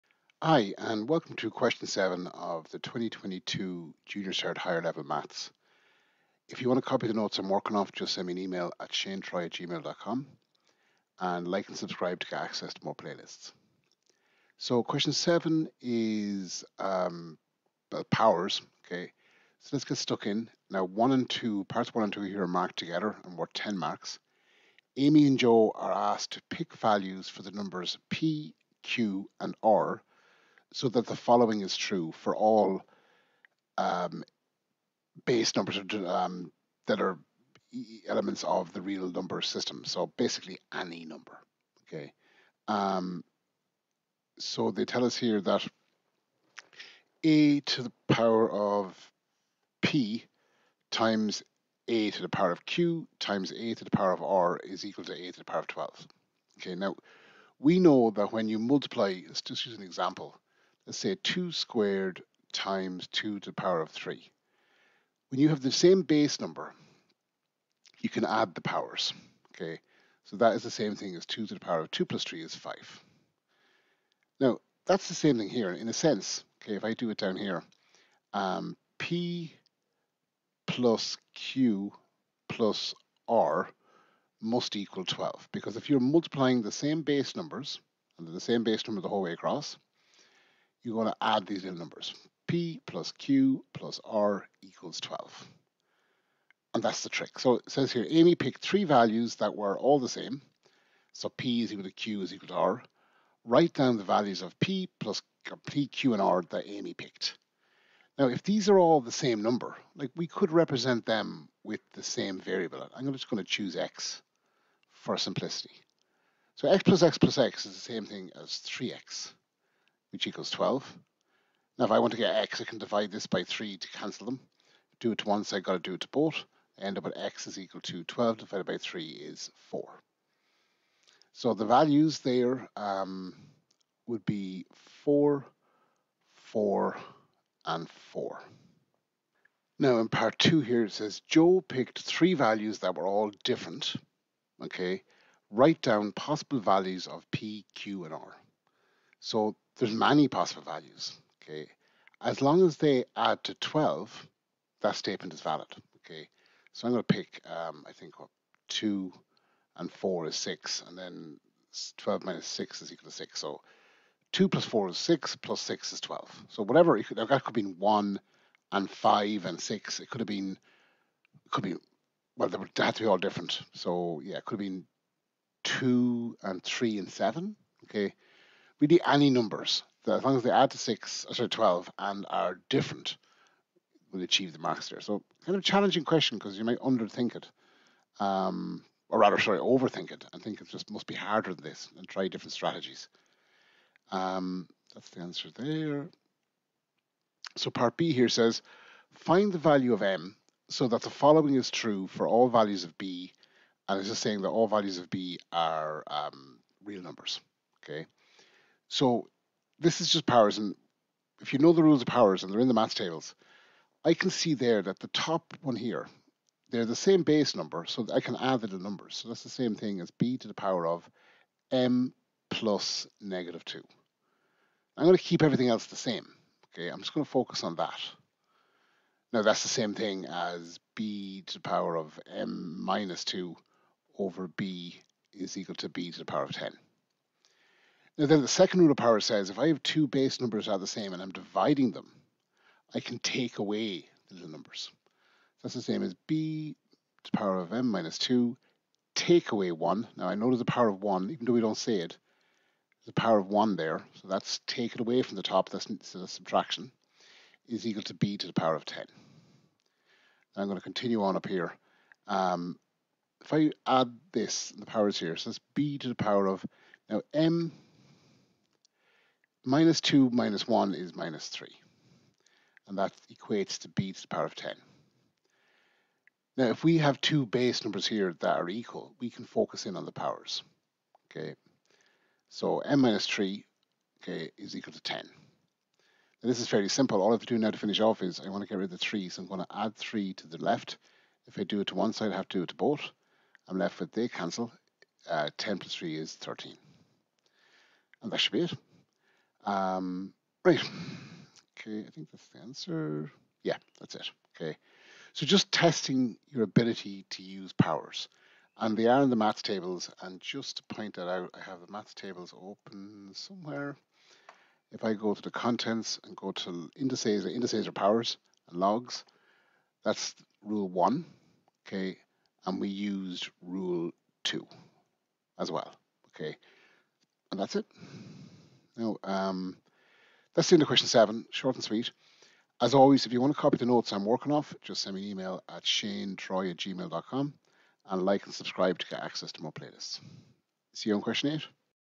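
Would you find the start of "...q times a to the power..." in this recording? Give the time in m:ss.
0:52.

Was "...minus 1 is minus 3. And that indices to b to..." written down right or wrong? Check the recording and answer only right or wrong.
wrong.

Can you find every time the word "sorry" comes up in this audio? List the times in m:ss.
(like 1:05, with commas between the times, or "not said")
3:01, 3:09.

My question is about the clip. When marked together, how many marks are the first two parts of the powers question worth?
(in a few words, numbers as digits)
10.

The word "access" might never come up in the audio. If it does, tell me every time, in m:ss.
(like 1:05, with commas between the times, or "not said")
0:12, 5:39.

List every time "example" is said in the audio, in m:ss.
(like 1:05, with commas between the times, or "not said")
0:59.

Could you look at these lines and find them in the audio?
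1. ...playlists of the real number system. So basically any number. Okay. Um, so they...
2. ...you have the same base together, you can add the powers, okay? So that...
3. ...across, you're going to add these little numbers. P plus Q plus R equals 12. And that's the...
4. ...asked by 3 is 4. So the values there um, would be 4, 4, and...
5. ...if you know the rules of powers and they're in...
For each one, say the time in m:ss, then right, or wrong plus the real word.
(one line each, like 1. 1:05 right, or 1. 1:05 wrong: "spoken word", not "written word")
1. 0:38 wrong: "elements", not "playlists"
2. 1:05 wrong: "number", not "together"
3. 1:29 right
4. 2:08 wrong: "divided", not "asked"
5. 3:31 right.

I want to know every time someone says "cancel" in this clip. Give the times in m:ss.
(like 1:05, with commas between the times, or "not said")
2:03, 4:54.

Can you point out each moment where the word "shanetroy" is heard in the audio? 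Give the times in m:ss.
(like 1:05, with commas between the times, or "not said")
0:08, 5:35.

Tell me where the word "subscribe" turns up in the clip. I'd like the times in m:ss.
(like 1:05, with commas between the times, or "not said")
0:11, 5:38.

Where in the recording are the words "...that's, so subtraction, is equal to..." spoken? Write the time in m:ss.
4:15.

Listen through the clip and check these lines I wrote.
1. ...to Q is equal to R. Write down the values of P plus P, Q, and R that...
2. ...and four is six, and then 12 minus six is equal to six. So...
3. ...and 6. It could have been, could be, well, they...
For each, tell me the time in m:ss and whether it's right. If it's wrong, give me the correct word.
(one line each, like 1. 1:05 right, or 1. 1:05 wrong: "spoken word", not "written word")
1. 1:41 right
2. 2:39 right
3. 2:49 right.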